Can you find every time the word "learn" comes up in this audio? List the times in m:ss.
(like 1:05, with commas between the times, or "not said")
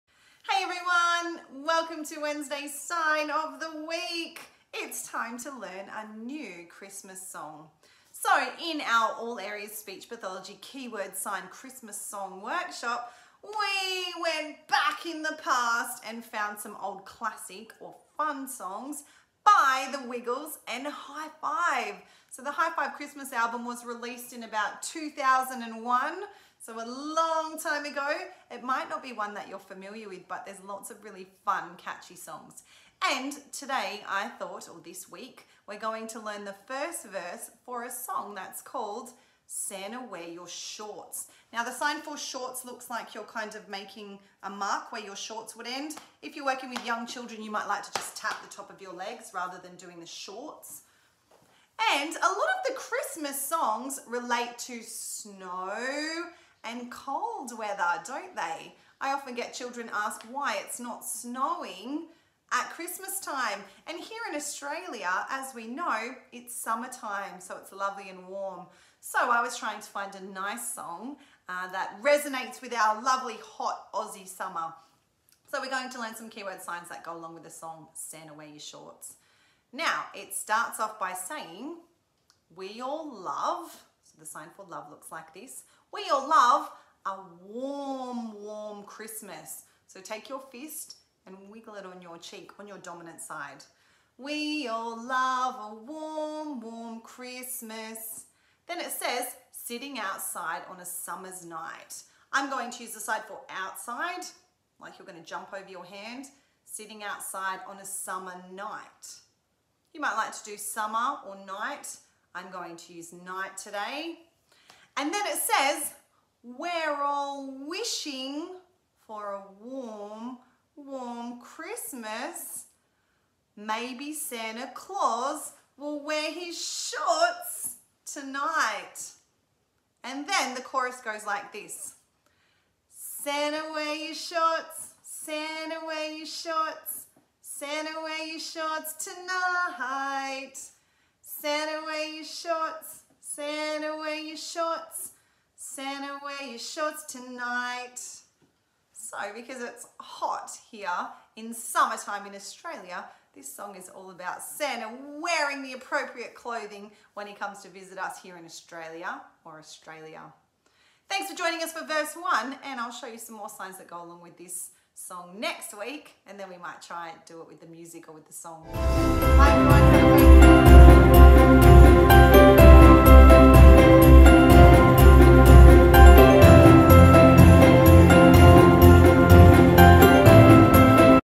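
0:05, 0:36, 1:15.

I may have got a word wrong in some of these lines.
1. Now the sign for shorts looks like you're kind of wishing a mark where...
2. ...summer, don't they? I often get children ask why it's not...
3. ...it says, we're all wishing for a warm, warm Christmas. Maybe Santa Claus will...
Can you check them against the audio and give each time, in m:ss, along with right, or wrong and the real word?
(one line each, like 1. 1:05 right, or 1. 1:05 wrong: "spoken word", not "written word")
1. 0:41 wrong: "making", not "wishing"
2. 0:57 wrong: "weather", not "summer"
3. 1:55 right.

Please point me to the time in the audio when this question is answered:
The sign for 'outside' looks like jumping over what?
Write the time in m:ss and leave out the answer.
1:45.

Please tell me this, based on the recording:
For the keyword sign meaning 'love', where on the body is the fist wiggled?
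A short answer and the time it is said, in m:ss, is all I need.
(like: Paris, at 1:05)
Cheek, at 1:32.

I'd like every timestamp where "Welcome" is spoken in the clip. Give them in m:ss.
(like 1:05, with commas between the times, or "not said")
0:01.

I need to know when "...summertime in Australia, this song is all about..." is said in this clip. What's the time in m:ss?
2:31.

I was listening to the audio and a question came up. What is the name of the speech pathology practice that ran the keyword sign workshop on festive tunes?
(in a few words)
All Areas Speech Pathology.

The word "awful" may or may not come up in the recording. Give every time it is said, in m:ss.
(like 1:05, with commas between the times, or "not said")
not said.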